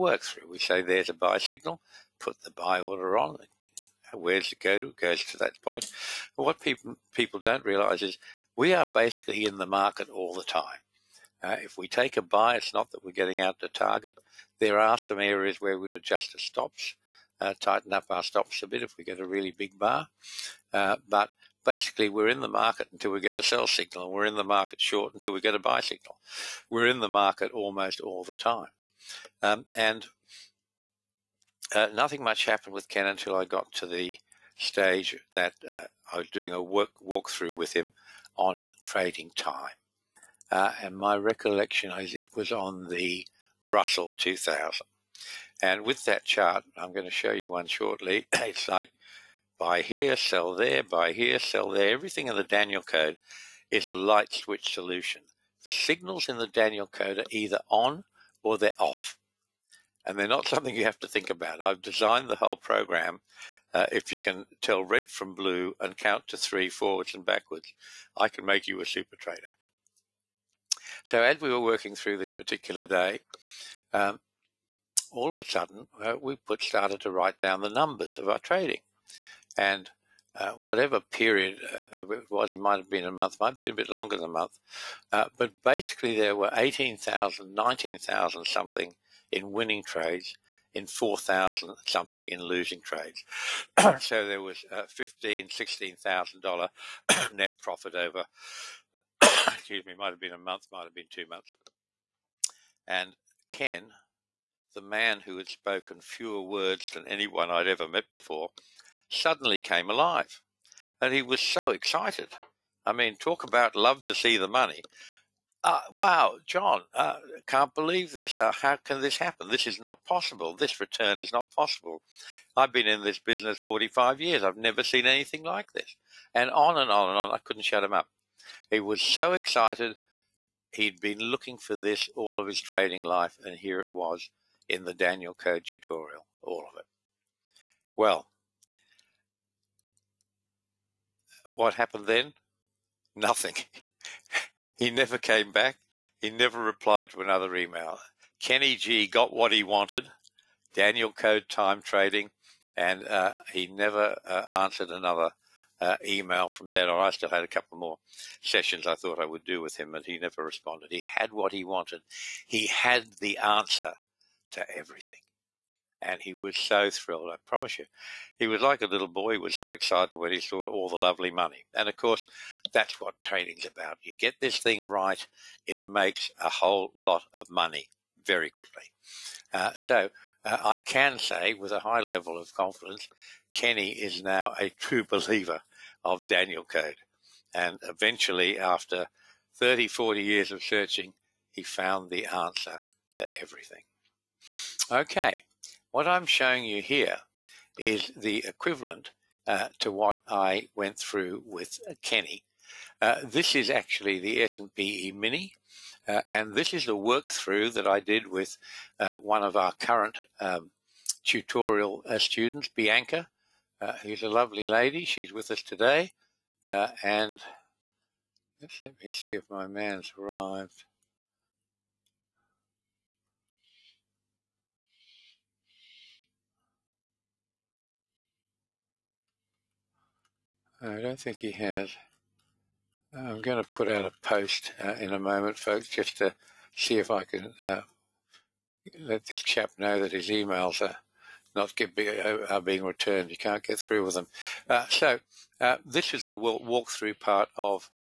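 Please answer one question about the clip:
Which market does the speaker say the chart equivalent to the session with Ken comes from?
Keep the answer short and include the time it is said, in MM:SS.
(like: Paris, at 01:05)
S&P Mini, at 03:24.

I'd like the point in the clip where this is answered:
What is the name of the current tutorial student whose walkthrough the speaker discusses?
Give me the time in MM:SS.
03:32.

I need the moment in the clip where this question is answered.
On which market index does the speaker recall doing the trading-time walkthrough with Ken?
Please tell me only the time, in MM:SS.
00:43.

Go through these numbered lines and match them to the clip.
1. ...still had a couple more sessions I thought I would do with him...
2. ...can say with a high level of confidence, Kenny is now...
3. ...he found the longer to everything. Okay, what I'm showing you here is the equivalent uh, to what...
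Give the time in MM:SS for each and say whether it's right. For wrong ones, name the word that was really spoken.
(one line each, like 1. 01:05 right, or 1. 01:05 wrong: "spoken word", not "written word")
1. 02:37 right
2. 03:00 right
3. 03:11 wrong: "answer", not "longer".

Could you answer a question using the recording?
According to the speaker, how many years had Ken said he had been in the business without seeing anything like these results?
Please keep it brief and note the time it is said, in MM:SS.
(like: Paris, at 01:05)
45 years, at 02:03.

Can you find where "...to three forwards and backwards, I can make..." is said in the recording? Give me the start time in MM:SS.
01:06.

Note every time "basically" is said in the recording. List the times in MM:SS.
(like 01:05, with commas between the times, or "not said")
00:08, 00:21, 01:25.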